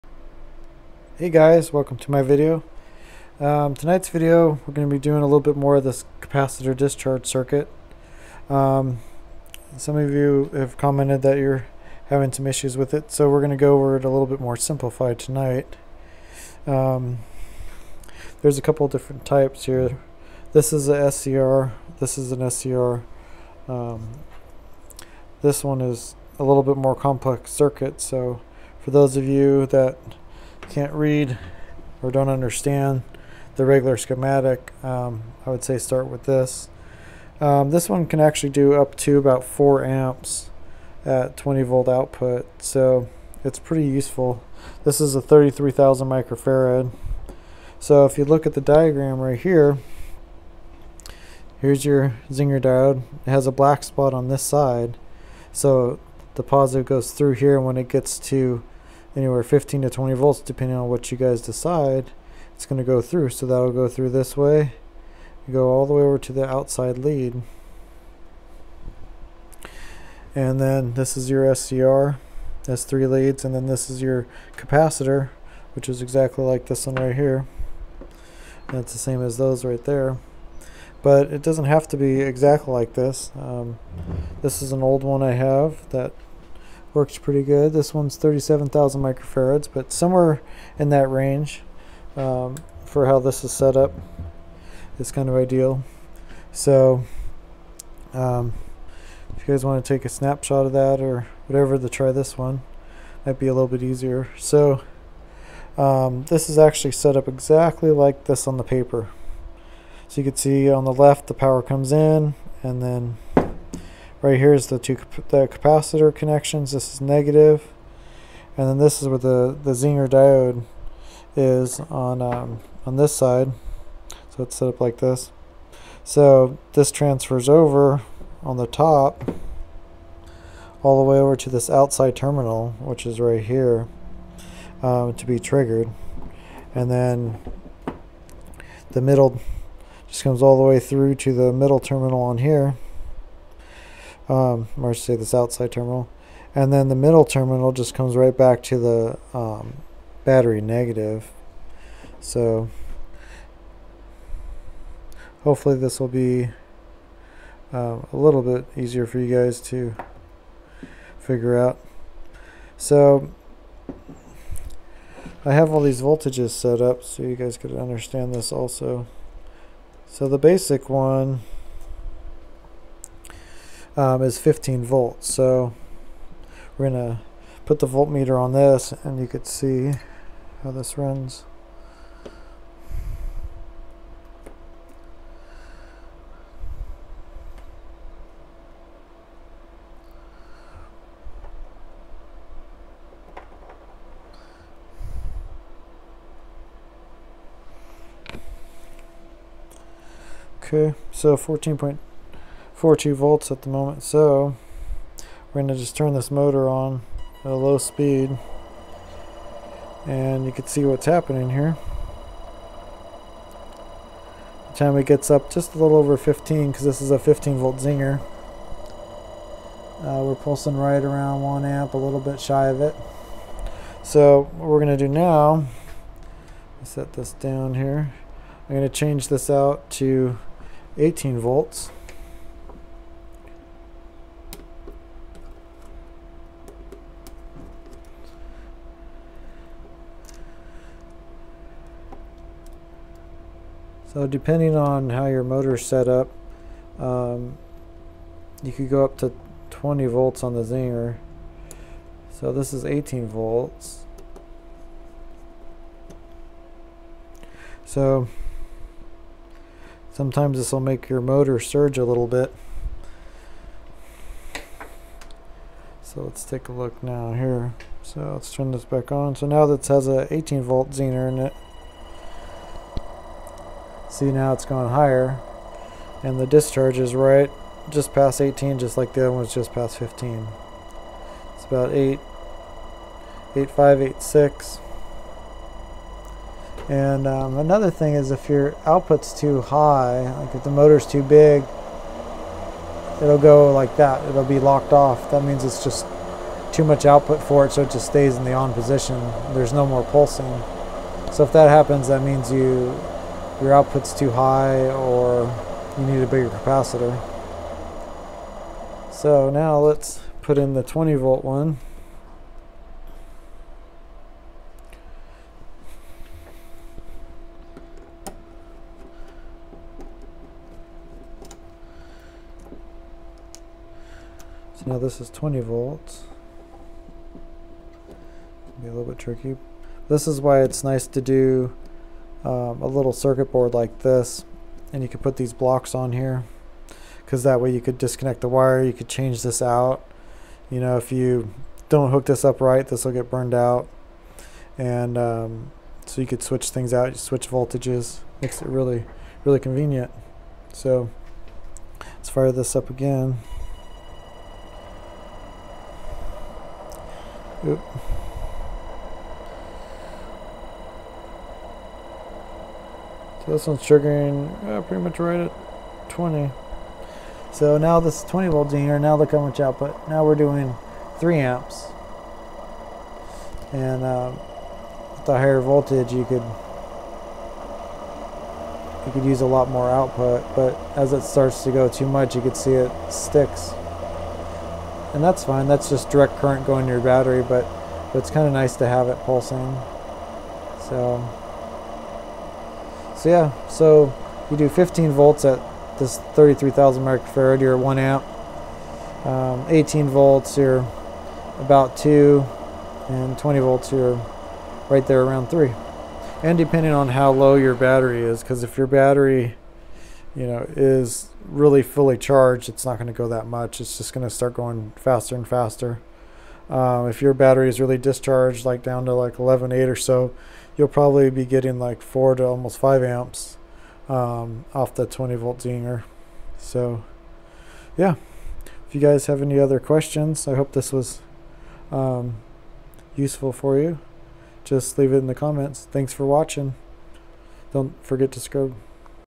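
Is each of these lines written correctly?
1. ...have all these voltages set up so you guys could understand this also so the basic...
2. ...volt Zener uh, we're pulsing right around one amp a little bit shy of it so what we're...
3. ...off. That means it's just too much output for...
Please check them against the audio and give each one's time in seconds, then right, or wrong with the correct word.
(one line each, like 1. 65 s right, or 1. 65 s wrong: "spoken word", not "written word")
1. 165 s right
2. 217 s right
3. 294 s right.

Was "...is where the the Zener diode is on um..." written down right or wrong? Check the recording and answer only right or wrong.
right.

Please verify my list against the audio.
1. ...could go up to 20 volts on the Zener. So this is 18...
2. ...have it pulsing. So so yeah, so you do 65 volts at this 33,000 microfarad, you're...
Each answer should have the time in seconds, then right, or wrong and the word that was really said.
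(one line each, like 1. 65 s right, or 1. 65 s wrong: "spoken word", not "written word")
1. 248 s right
2. 388 s wrong: "15", not "65".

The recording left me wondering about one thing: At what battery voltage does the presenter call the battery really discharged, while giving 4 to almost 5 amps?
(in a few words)
11.8.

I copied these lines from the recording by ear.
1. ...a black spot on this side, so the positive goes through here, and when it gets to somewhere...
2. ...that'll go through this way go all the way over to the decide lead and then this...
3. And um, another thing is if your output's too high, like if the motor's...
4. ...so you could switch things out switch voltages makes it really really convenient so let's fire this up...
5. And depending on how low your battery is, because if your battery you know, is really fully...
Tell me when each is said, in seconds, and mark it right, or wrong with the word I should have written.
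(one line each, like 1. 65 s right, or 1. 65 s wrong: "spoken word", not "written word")
1. 53 s wrong: "anywhere", not "somewhere"
2. 63 s wrong: "outside", not "decide"
3. 286 s right
4. 346 s right
5. 406 s right.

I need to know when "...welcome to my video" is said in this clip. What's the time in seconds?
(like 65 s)
1 s.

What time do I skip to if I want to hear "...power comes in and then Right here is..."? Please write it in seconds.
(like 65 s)
111 s.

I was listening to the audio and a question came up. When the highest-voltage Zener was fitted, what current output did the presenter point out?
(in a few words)
3 amps.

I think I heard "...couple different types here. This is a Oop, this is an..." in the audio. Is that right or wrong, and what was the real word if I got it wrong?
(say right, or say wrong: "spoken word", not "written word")
wrong: "SCR", not "Oop".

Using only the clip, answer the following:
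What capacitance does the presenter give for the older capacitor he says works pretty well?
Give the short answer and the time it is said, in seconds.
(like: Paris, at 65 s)
37,000 microfarads, at 88 s.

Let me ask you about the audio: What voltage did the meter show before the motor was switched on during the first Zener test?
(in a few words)
14.242 volts.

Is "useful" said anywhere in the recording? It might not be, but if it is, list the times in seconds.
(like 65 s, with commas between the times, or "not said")
43 s, 433 s.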